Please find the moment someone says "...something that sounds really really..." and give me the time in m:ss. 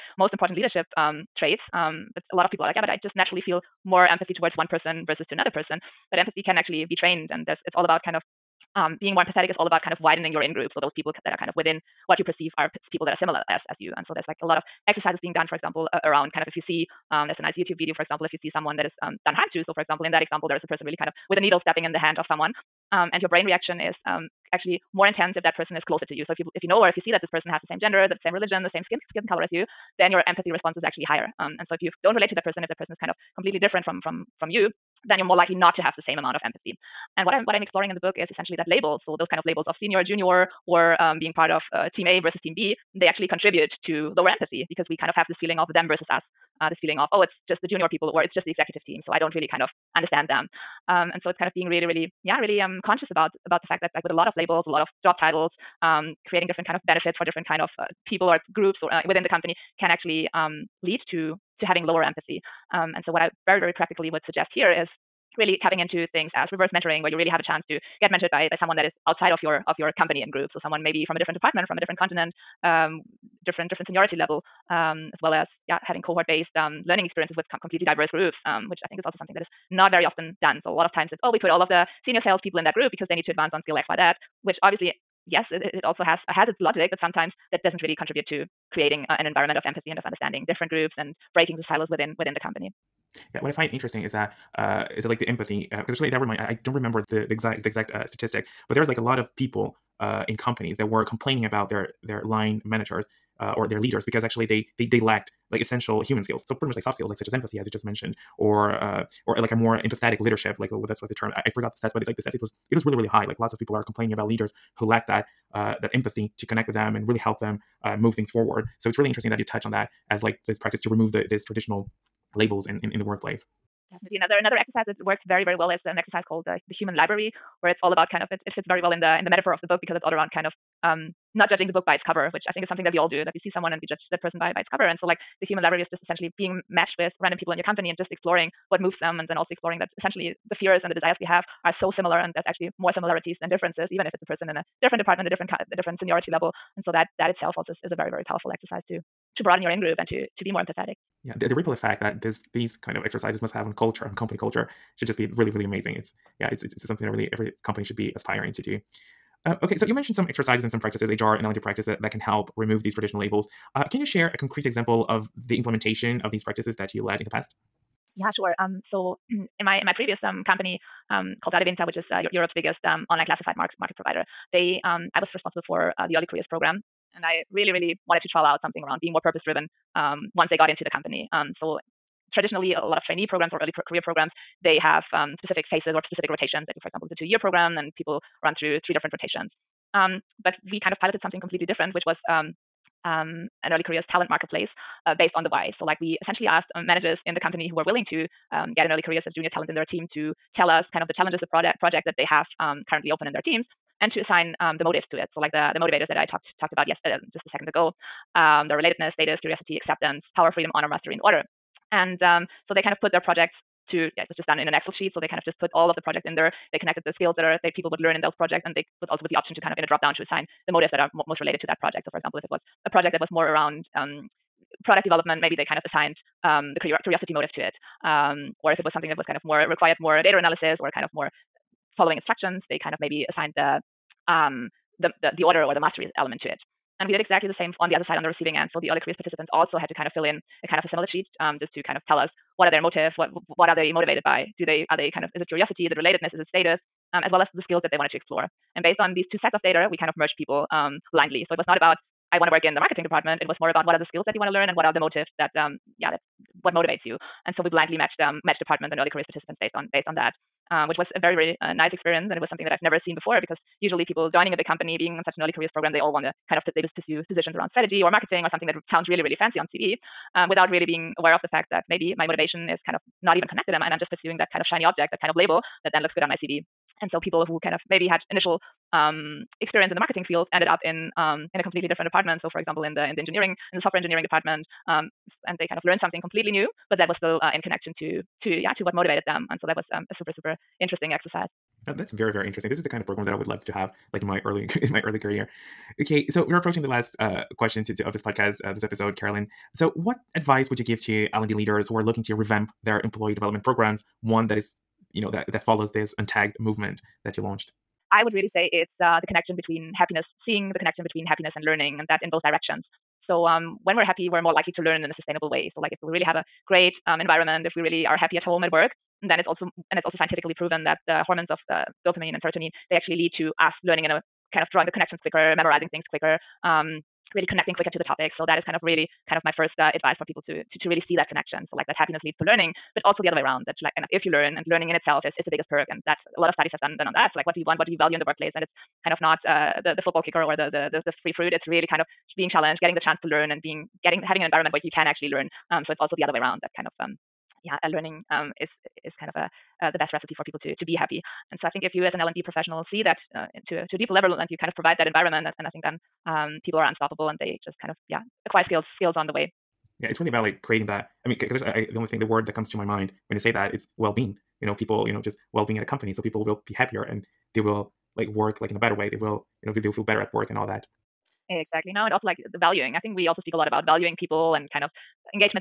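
4:28.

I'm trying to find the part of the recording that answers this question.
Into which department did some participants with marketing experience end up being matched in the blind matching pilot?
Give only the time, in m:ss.
4:43.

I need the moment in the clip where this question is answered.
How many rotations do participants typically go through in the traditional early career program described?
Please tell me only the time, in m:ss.
3:08.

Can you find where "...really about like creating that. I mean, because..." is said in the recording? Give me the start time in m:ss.
6:00.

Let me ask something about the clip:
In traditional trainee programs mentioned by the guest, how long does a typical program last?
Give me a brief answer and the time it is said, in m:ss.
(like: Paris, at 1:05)
2 years, at 3:07.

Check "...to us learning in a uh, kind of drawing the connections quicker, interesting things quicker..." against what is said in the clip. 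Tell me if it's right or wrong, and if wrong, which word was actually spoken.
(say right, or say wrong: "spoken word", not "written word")
wrong: "memorizing", not "interesting".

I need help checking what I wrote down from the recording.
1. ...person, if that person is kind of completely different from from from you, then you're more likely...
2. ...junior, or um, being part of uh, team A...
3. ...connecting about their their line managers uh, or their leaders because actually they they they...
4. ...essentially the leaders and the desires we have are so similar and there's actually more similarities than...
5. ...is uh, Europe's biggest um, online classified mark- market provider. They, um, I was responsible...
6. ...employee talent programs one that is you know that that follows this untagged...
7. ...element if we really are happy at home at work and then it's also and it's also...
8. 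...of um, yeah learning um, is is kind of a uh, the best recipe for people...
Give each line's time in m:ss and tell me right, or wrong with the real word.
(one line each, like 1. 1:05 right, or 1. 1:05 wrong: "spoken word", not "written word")
1. 0:32 right
2. 0:40 right
3. 1:41 wrong: "complaining", not "connecting"
4. 2:20 wrong: "fears", not "leaders"
5. 2:51 right
6. 5:03 wrong: "development", not "talent"
7. 5:17 wrong: "environment", not "element"
8. 5:46 right.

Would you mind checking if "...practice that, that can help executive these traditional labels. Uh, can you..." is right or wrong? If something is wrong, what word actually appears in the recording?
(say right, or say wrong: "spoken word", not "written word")
wrong: "remove", not "executive".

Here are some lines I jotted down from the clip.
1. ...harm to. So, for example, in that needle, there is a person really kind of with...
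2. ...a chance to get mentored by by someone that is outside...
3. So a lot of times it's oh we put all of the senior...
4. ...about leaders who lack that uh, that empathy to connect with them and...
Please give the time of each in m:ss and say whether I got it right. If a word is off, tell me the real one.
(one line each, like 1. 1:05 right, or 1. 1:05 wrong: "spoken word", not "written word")
1. 0:19 wrong: "example", not "needle"
2. 1:07 right
3. 1:20 right
4. 1:54 right.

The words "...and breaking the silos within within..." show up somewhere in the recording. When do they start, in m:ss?
1:30.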